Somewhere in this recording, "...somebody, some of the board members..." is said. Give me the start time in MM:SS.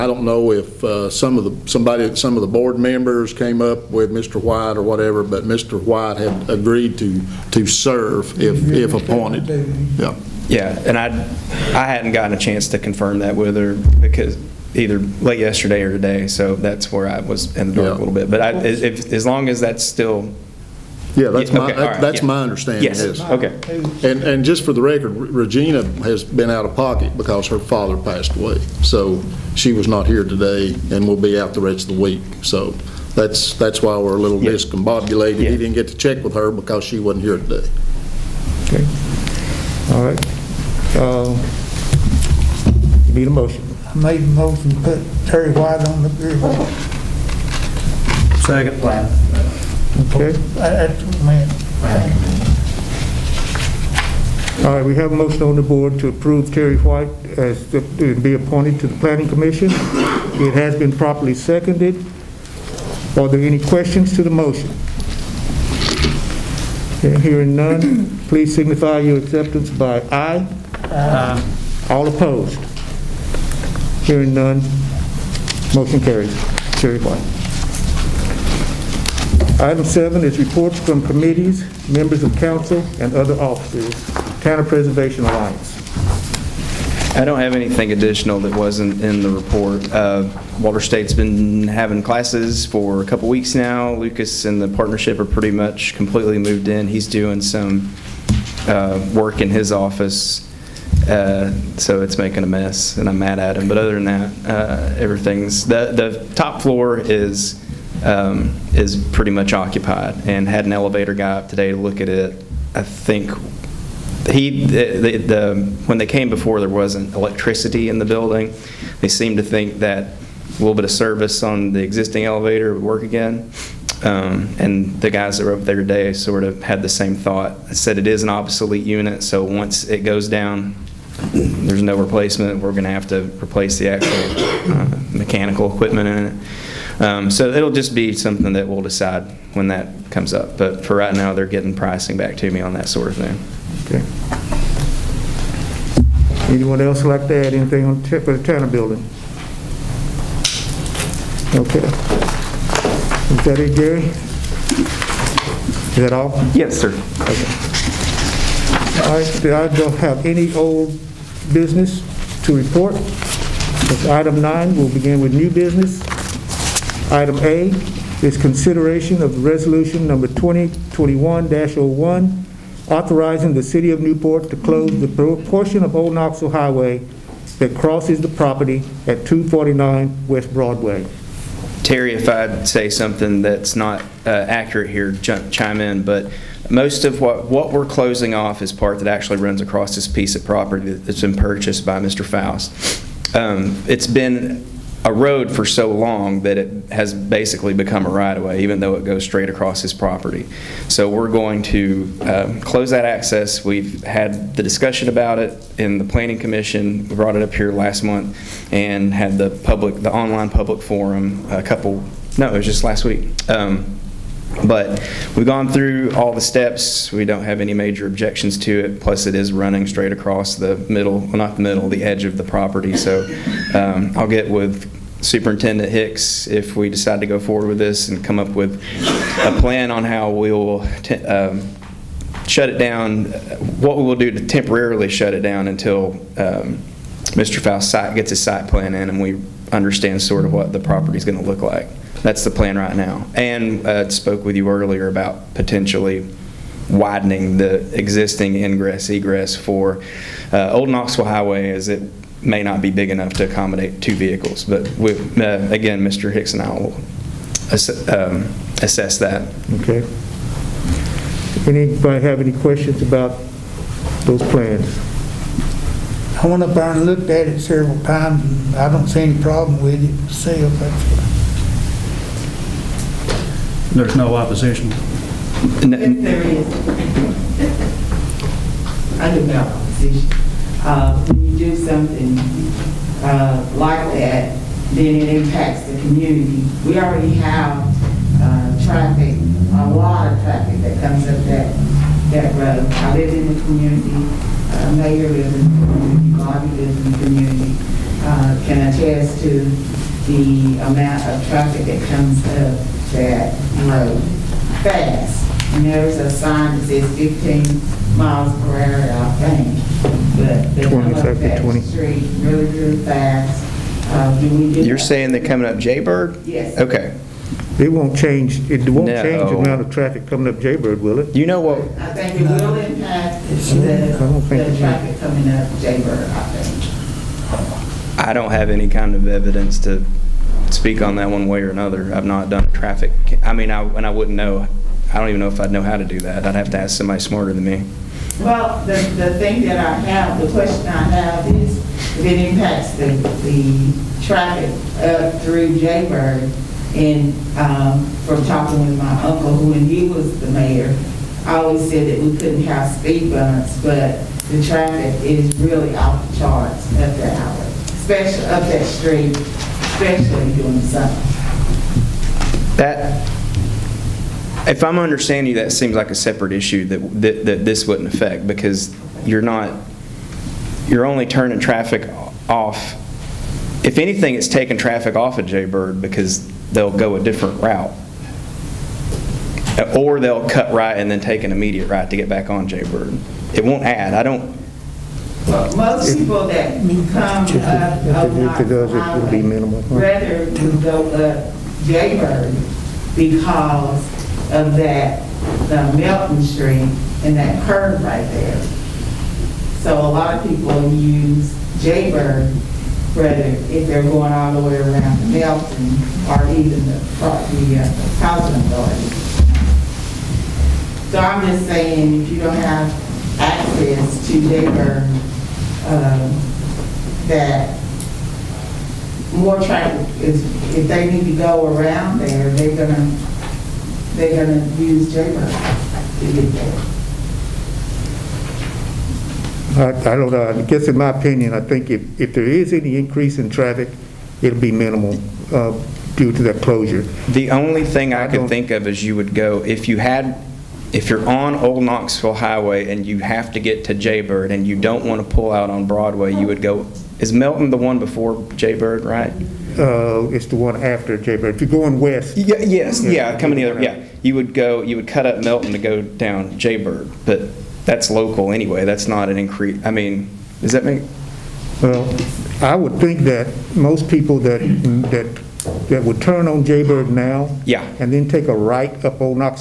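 00:01.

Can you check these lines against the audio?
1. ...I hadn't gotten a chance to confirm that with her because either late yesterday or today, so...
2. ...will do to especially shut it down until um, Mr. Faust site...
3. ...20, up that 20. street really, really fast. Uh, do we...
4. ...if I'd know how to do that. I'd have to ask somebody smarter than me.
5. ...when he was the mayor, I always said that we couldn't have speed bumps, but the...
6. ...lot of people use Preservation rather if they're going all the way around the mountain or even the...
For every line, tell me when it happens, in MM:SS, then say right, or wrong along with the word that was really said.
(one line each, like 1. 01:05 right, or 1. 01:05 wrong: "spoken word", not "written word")
1. 00:11 right
2. 03:54 wrong: "temporarily", not "especially"
3. 05:10 right
4. 05:35 right
5. 05:49 right
6. 06:40 wrong: "Jaybird", not "Preservation".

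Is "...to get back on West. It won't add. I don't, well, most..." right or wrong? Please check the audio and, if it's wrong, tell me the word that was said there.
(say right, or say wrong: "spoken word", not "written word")
wrong: "Jaybird", not "West".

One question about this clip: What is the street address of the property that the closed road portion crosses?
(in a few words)
249 West Broadway.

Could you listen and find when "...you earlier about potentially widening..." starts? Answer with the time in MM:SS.
04:04.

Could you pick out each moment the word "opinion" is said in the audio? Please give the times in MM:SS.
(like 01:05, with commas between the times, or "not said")
07:11.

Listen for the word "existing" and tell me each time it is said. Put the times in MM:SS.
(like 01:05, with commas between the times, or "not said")
02:01, 04:07.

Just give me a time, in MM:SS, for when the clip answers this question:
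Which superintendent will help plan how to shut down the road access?
03:45.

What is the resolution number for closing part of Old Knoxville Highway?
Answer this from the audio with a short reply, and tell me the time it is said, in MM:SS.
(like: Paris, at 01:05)
2021-01, at 02:50.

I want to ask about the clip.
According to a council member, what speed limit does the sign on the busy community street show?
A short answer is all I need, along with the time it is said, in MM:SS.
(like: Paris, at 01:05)
15 miles per hour, at 05:07.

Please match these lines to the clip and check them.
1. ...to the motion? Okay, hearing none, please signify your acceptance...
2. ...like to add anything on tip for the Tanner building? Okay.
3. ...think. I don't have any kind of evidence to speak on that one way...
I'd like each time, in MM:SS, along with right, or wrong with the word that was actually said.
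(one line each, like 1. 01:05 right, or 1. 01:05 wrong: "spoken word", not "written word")
1. 01:04 right
2. 02:27 right
3. 05:26 right.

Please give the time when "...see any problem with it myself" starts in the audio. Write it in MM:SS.
04:29.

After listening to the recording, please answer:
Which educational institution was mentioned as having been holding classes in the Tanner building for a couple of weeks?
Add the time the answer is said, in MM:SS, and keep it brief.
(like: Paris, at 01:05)
Walters State, at 01:30.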